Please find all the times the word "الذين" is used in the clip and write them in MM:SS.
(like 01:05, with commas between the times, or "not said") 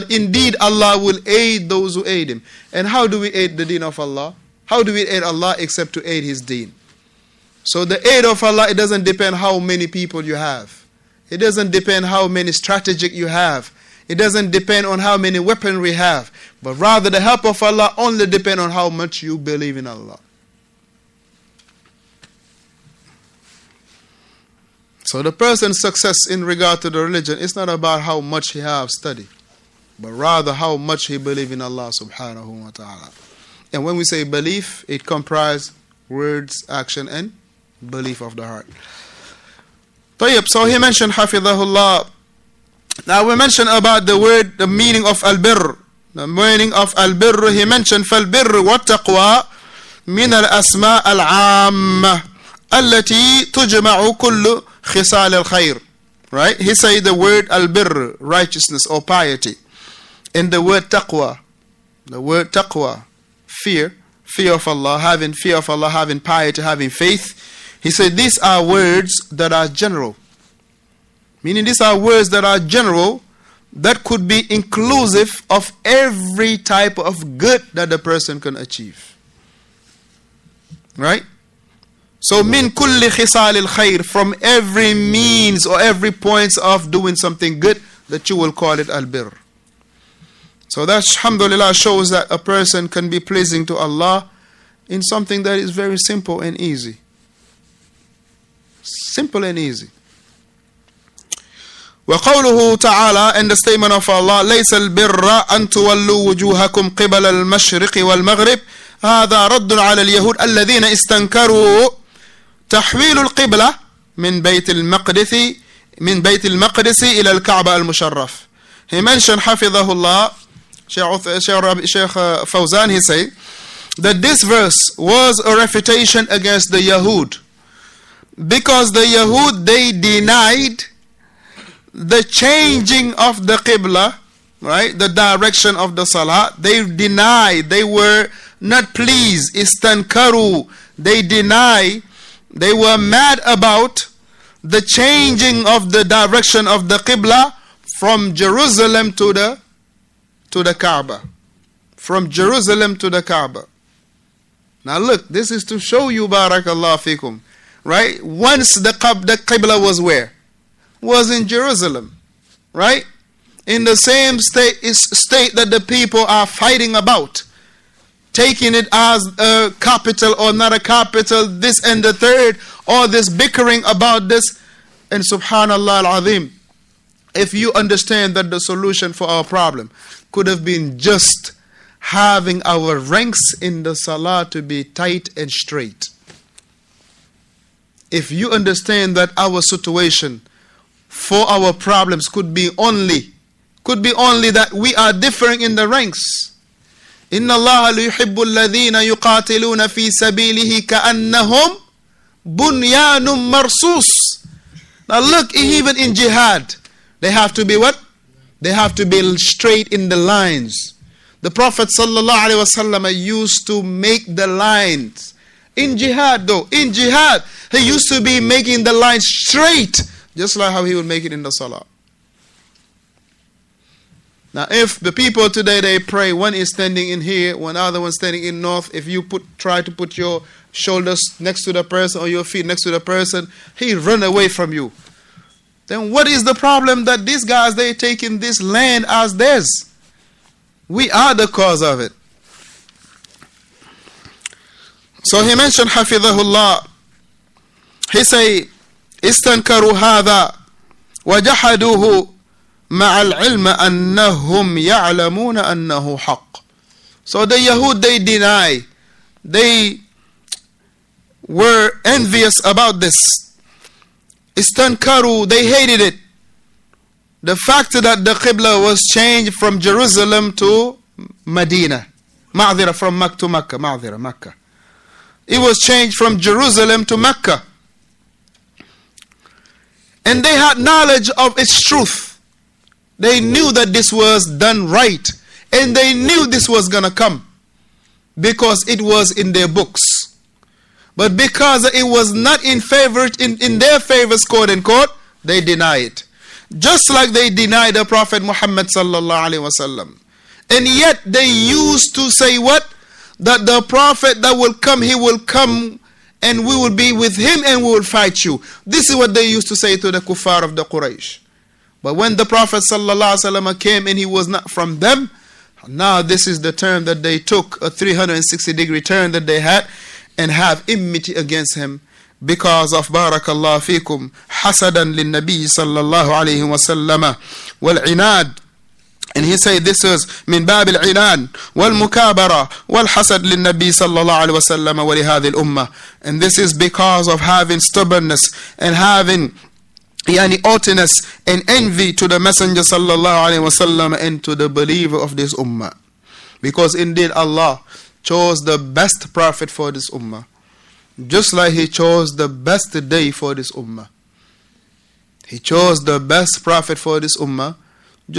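01:50, 03:18.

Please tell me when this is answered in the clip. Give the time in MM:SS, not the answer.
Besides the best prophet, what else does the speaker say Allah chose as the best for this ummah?
05:52.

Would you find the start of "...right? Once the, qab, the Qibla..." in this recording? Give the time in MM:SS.
02:37.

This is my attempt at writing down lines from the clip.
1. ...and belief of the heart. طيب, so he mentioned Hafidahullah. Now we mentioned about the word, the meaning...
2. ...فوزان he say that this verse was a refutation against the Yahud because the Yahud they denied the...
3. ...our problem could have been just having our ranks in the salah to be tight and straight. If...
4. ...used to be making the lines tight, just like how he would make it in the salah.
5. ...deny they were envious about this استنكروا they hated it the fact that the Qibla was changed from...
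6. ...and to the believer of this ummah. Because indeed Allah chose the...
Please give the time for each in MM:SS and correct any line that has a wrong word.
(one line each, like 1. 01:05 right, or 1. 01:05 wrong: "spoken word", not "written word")
1. 00:37 right
2. 02:02 right
3. 02:59 right
4. 03:37 wrong: "straight", not "tight"
5. 04:18 right
6. 05:44 right.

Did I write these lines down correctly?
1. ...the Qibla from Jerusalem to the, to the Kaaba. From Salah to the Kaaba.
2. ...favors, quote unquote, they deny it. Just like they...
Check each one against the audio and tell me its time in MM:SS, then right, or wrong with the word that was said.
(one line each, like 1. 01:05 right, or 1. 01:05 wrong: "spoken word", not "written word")
1. 02:26 wrong: "Jerusalem", not "Salah"
2. 04:53 right.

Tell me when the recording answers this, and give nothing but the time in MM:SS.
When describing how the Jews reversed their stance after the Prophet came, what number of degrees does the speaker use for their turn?
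05:17.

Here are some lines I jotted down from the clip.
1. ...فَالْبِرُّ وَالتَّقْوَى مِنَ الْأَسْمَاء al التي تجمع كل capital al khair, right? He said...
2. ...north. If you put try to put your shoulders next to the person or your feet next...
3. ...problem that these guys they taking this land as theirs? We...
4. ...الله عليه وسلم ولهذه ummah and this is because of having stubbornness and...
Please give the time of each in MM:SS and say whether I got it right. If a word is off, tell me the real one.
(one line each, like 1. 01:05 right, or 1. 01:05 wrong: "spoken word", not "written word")
1. 00:48 wrong: "khisal", not "capital"
2. 03:48 right
3. 03:56 right
4. 05:34 right.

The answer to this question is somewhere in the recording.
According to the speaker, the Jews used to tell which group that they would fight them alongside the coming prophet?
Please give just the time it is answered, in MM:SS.
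05:10.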